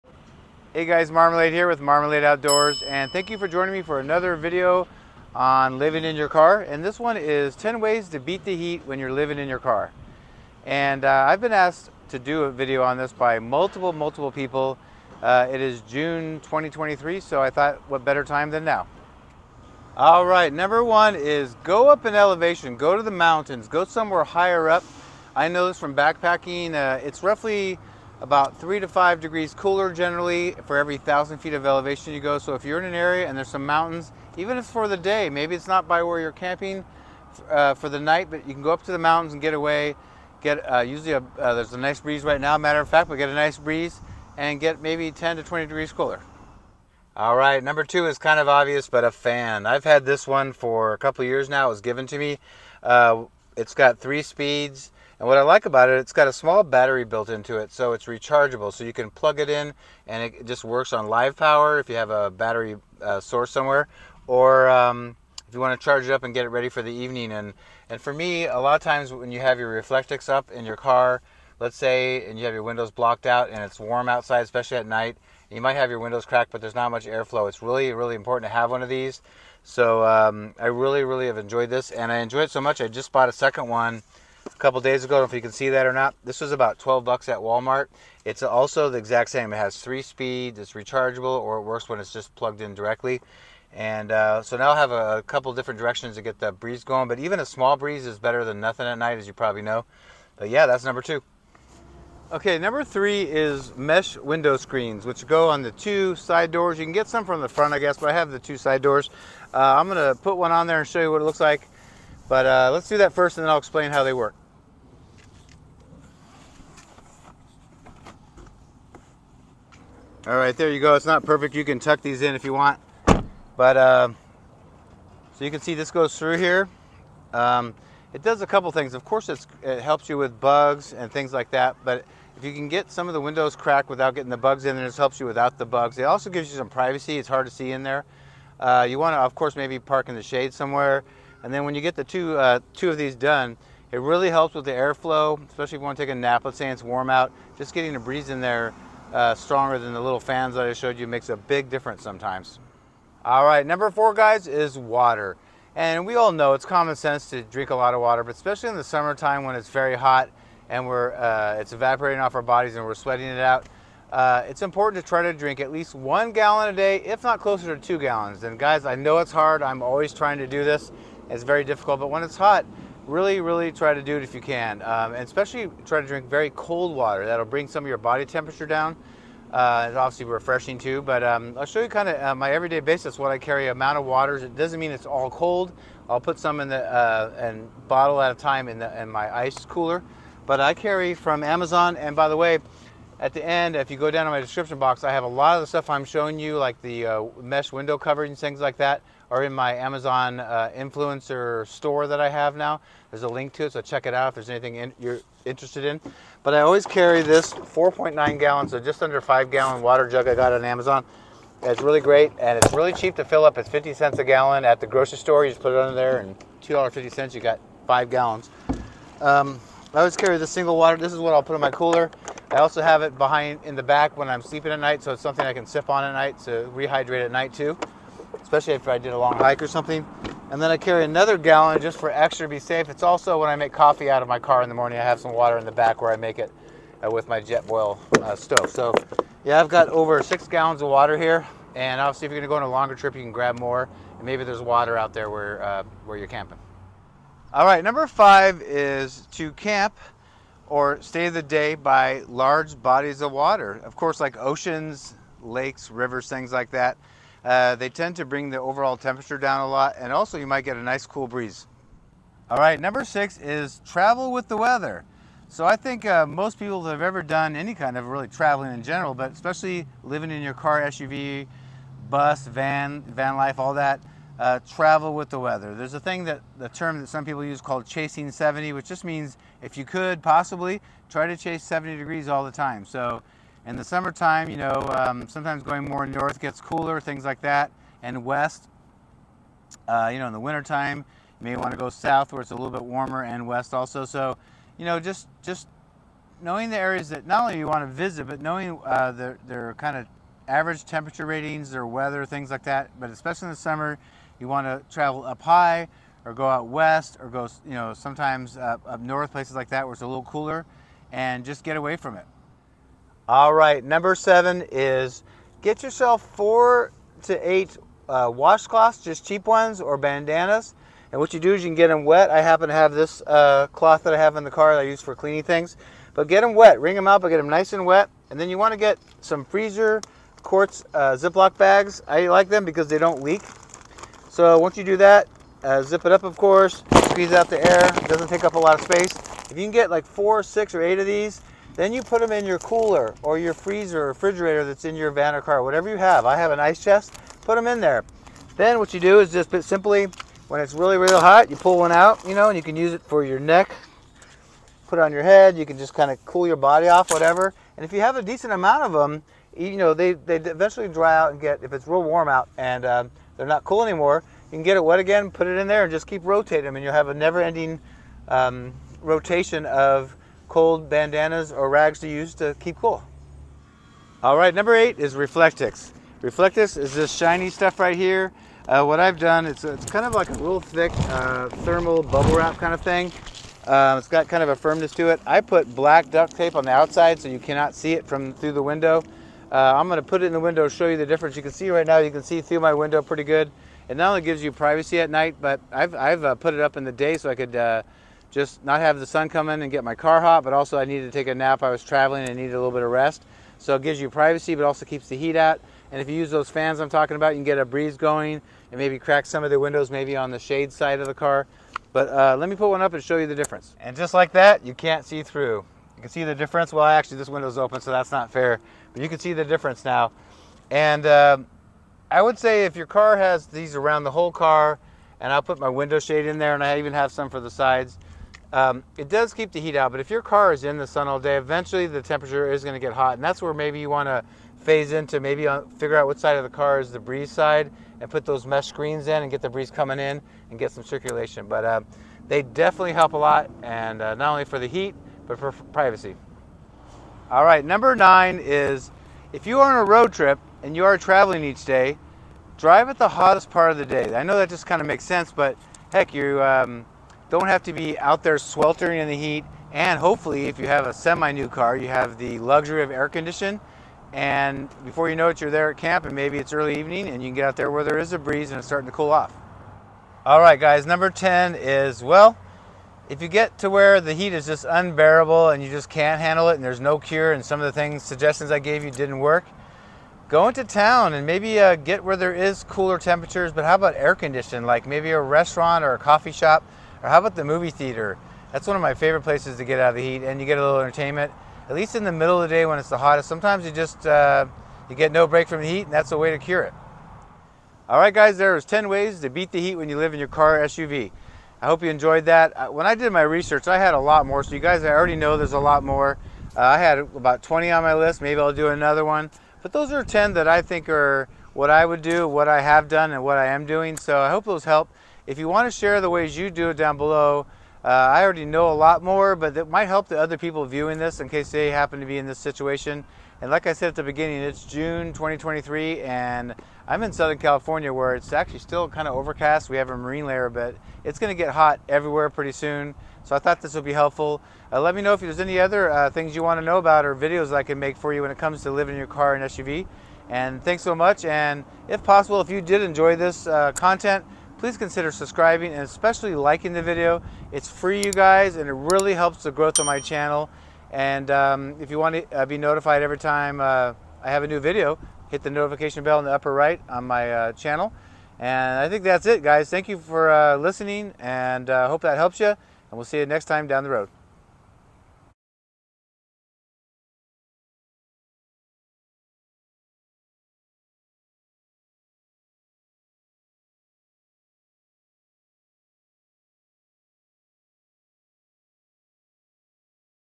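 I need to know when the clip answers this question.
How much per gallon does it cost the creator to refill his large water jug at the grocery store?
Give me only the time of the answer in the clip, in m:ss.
3:33.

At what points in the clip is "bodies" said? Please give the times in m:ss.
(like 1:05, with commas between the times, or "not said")
2:42, 4:12.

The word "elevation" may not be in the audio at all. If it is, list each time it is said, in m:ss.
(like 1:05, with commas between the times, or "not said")
0:22, 0:31.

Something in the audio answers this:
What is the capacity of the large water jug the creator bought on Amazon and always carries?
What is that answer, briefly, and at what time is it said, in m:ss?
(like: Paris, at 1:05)
4.9 gallons, at 3:27.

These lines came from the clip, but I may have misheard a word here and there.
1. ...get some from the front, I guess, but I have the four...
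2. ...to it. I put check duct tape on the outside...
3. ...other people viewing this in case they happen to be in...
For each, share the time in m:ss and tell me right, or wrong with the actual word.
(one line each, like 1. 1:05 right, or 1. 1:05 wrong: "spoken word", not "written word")
1. 1:46 wrong: "two", not "four"
2. 6:24 wrong: "black", not "check"
3. 8:40 right.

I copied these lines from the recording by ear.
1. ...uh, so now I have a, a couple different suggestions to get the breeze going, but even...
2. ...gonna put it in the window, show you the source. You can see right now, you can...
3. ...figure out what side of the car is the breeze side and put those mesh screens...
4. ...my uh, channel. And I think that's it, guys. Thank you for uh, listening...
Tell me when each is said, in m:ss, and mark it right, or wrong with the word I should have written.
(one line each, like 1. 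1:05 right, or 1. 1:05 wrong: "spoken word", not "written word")
1. 1:34 wrong: "directions", not "suggestions"
2. 6:29 wrong: "difference", not "source"
3. 7:15 right
4. 9:17 right.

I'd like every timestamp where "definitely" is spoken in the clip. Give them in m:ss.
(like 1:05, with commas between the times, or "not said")
7:22.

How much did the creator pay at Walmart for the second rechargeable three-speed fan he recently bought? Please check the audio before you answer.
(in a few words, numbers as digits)
$12.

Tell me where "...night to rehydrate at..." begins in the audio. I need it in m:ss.
3:46.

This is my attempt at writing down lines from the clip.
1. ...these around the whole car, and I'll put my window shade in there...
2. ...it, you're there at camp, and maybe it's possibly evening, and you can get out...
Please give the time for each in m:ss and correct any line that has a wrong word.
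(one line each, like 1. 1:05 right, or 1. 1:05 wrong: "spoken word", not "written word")
1. 7:03 right
2. 7:45 wrong: "early", not "possibly".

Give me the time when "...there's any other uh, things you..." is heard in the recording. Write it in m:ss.
8:55.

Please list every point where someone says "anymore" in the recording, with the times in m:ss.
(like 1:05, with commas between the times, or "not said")
6:03.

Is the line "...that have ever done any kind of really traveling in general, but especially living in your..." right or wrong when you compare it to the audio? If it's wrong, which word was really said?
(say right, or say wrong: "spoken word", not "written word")
right.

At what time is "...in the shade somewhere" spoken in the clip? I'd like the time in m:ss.
2:20.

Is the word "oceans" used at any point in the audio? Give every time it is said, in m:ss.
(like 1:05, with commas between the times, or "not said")
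4:14.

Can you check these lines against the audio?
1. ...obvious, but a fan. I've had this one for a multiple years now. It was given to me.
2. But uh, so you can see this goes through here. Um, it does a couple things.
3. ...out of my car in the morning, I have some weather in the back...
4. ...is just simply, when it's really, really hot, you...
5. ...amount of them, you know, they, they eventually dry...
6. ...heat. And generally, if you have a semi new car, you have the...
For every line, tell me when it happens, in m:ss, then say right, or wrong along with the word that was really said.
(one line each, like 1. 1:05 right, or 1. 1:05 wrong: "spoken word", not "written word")
1. 0:48 wrong: "couple", not "multiple"
2. 2:03 right
3. 3:54 wrong: "water", not "weather"
4. 5:49 right
5. 5:58 right
6. 7:39 wrong: "hopefully", not "generally".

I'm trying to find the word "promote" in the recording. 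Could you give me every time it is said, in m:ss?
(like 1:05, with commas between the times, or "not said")
not said.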